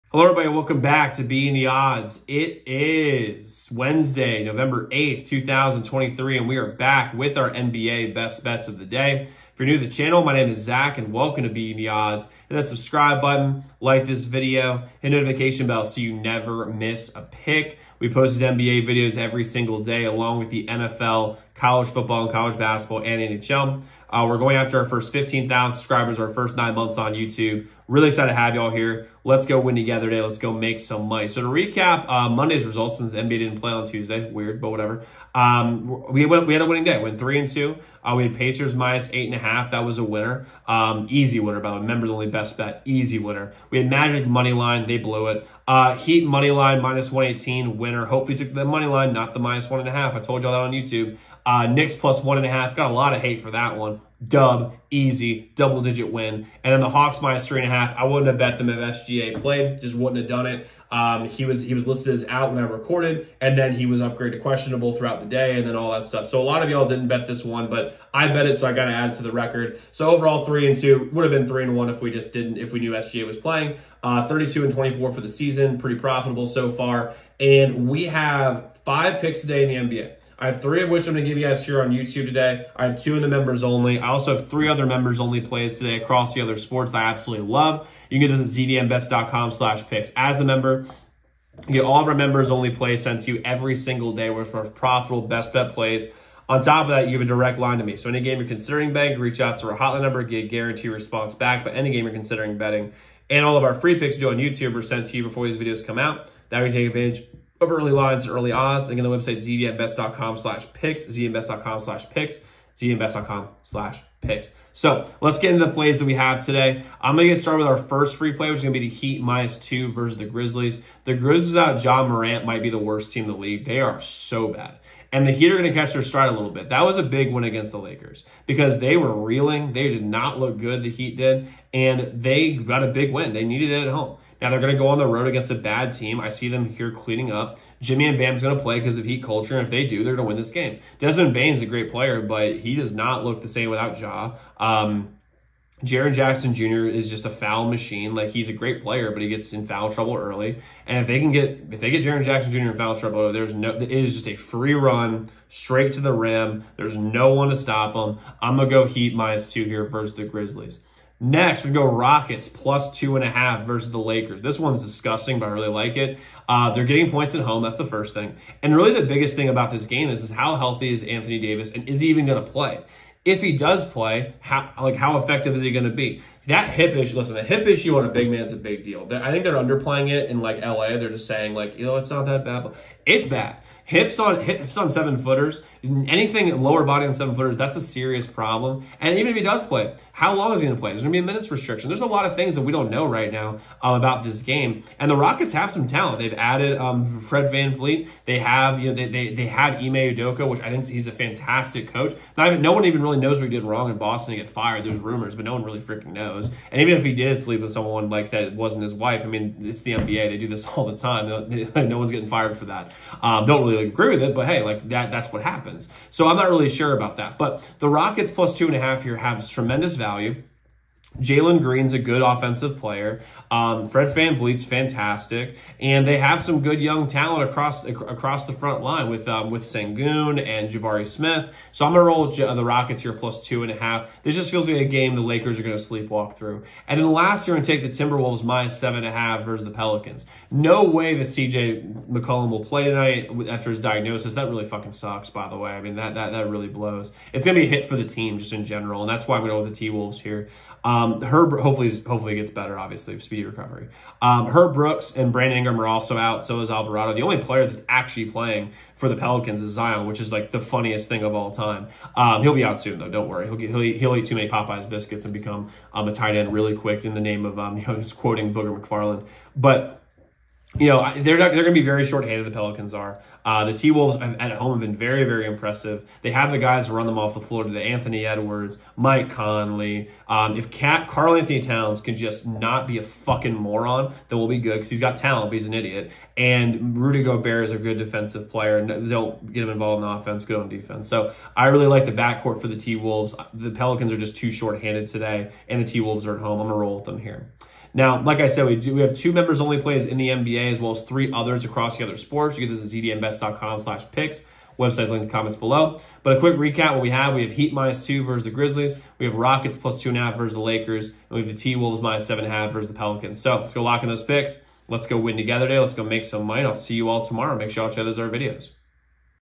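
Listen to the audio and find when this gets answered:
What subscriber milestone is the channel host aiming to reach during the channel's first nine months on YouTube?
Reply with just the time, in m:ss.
0:25.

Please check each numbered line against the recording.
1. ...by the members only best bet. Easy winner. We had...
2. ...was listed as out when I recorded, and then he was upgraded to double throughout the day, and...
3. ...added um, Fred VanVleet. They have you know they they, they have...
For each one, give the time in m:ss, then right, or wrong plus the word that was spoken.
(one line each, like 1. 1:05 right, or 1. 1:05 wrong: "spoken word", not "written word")
1. 0:41 right
2. 1:01 wrong: "questionable", not "double"
3. 3:16 right.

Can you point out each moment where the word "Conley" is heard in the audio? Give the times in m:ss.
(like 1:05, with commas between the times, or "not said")
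4:39.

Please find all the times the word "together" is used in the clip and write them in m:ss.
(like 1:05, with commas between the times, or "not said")
0:29, 5:15.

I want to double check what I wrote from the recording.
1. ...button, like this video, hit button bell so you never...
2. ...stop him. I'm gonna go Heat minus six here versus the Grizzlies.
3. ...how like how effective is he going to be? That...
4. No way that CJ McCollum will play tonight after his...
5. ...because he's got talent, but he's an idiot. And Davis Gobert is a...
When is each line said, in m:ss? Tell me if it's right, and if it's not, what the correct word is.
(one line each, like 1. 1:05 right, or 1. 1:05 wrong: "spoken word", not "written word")
1. 0:13 wrong: "notification", not "button"
2. 2:37 wrong: "two", not "six"
3. 2:54 right
4. 4:00 right
5. 4:44 wrong: "Rudy", not "Davis".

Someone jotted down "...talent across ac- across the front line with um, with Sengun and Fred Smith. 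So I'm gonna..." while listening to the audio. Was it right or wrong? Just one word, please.
wrong.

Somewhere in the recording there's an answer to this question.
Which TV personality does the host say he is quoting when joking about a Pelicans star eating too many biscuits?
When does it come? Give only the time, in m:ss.
4:28.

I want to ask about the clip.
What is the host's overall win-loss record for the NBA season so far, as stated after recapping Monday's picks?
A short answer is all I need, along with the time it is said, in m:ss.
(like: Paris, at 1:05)
32-24, at 1:14.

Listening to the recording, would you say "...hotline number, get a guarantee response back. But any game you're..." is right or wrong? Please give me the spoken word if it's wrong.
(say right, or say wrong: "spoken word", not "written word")
right.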